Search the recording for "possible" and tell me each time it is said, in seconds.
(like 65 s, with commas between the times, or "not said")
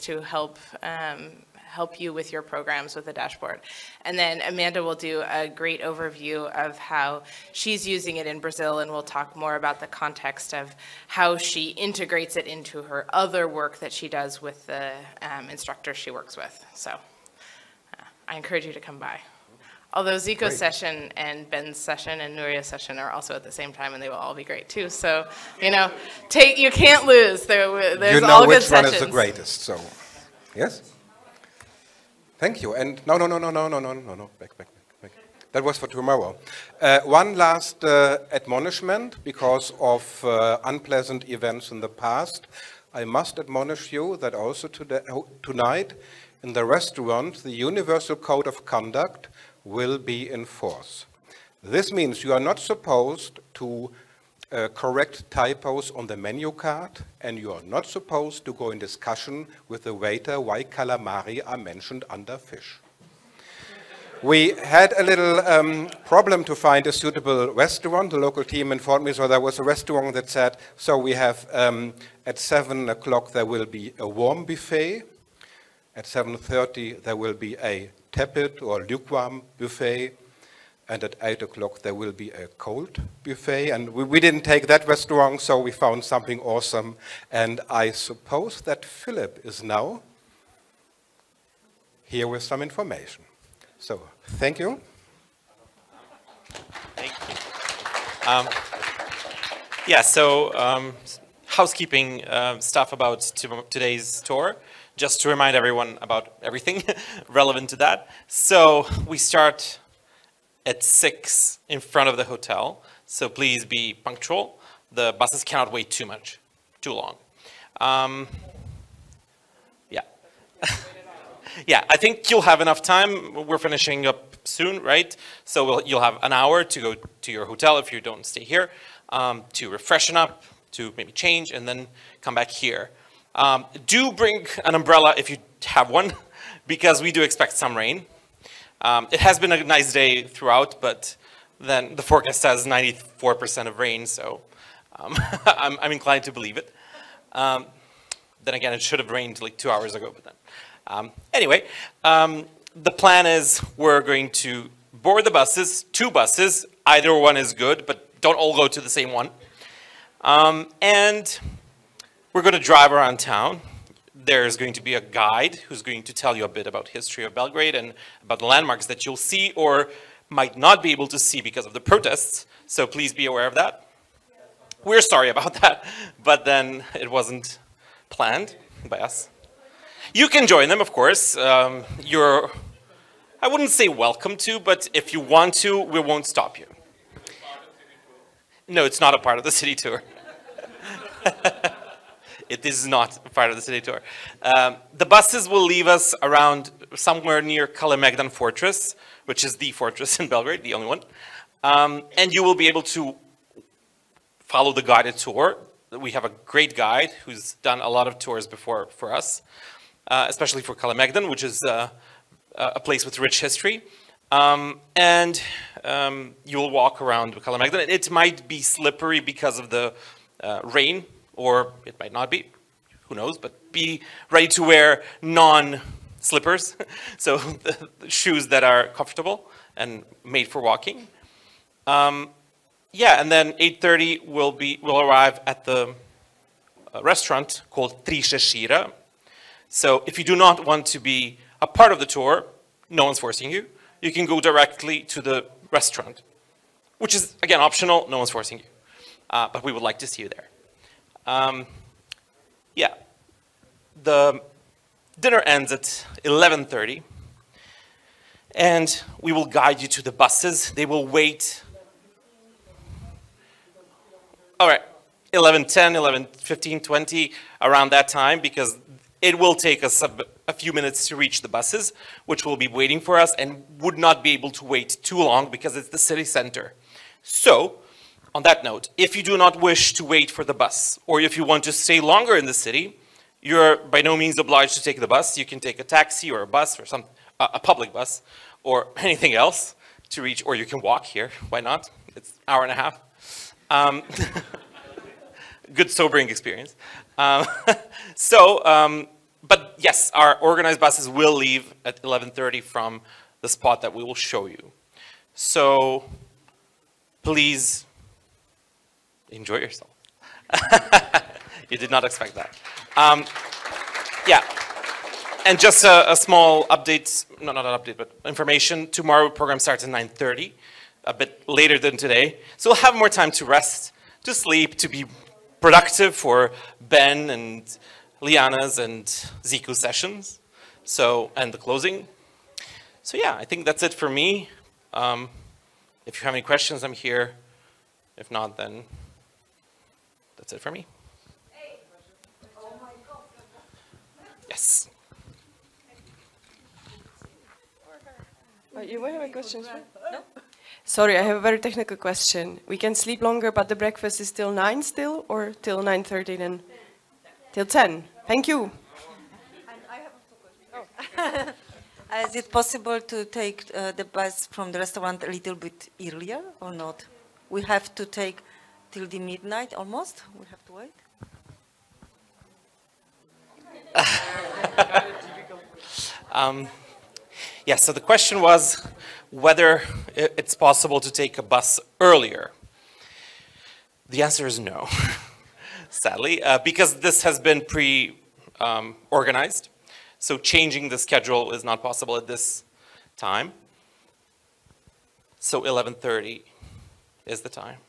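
362 s, 380 s, 391 s.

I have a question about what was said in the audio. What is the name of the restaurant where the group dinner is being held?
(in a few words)
Tri šešira.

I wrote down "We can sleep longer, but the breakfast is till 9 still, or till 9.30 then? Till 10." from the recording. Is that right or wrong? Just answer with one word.
right.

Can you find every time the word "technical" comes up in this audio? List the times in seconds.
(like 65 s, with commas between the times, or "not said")
351 s.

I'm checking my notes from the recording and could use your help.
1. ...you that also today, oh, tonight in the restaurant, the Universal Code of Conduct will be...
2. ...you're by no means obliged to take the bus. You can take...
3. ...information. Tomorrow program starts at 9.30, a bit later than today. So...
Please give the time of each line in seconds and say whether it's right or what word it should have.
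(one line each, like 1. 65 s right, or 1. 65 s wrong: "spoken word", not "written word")
1. 43 s right
2. 283 s right
3. 318 s right.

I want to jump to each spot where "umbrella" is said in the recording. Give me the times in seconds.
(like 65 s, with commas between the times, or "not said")
134 s.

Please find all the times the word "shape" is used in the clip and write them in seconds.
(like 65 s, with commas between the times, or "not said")
not said.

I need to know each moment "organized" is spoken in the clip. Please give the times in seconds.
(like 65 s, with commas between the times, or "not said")
300 s, 387 s.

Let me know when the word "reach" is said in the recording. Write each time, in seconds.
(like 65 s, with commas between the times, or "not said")
271 s, 290 s.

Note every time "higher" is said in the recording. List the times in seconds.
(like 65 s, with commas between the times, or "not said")
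not said.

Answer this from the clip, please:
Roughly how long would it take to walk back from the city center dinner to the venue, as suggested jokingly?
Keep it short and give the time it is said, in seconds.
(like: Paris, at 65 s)
hour and a half, at 292 s.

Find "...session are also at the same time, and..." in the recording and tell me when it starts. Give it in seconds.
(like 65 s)
22 s.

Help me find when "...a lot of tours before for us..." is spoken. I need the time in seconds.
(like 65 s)
207 s.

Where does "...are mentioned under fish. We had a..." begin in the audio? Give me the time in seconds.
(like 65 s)
61 s.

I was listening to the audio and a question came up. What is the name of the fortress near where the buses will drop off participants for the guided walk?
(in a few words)
Kalemegdan Fortress.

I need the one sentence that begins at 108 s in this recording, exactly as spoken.
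So we start at 6 in front of the hotel.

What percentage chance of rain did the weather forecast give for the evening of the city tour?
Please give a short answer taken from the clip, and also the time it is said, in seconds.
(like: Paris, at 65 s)
94%, at 142 s.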